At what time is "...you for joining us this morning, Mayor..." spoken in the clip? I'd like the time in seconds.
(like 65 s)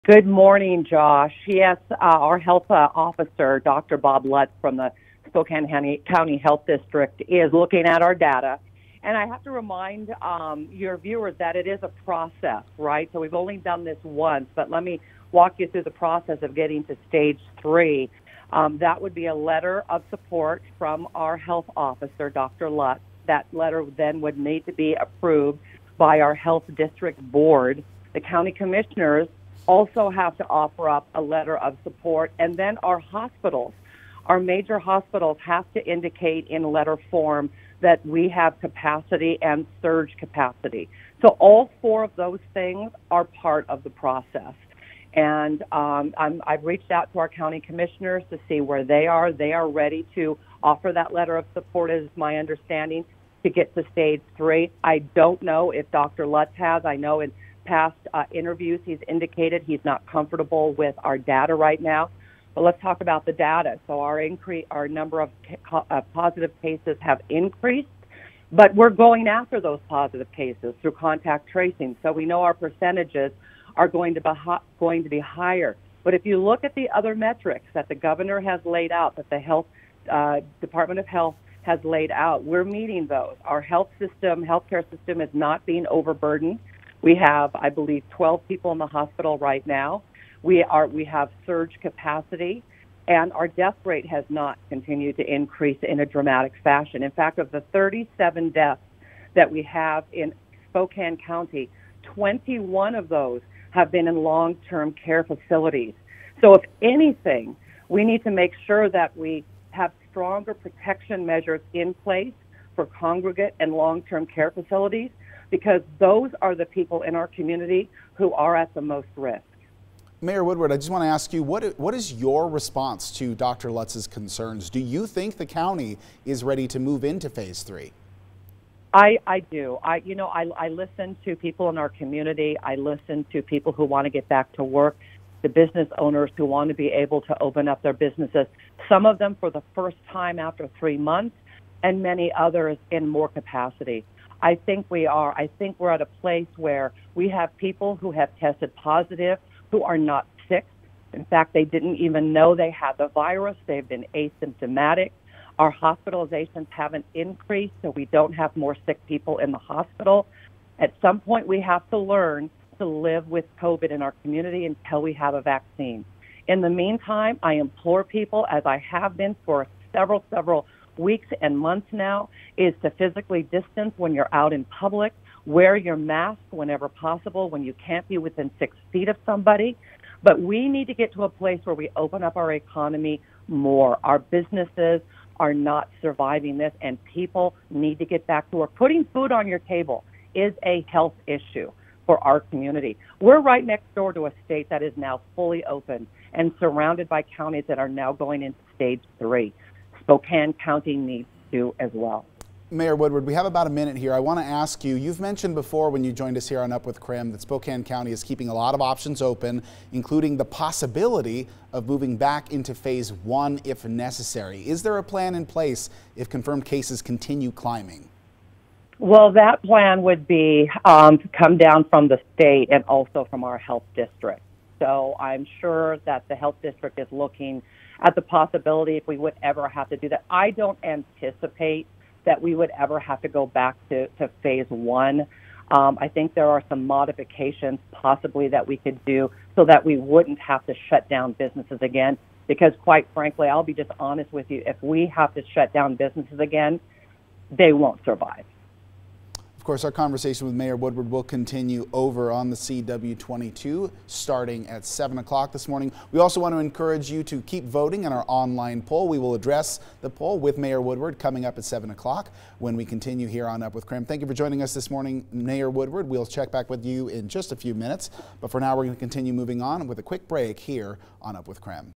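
264 s.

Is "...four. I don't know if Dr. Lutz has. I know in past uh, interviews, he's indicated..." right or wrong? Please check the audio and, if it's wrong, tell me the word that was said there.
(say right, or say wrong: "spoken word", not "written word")
wrong: "three", not "four".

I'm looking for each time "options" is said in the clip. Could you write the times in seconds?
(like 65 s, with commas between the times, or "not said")
208 s.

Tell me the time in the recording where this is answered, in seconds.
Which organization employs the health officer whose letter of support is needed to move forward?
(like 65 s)
5 s.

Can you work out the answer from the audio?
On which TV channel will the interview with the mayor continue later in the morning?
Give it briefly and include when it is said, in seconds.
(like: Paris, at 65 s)
CW22, at 252 s.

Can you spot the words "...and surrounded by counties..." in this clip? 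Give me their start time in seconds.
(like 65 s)
196 s.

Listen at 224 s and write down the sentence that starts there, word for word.
So I'm sure that the health district is looking at the possibility if we would ever have to do that.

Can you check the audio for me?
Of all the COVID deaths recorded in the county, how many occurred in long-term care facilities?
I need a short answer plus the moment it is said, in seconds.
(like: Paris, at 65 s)
21, at 102 s.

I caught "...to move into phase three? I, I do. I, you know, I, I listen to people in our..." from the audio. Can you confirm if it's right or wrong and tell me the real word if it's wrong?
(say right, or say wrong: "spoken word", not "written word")
right.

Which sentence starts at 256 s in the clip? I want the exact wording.
We also want to encourage you to keep voting in our online poll.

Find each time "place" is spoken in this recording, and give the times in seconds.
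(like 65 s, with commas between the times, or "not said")
111 s, 146 s, 181 s, 215 s.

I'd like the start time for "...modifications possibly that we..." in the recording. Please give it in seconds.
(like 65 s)
236 s.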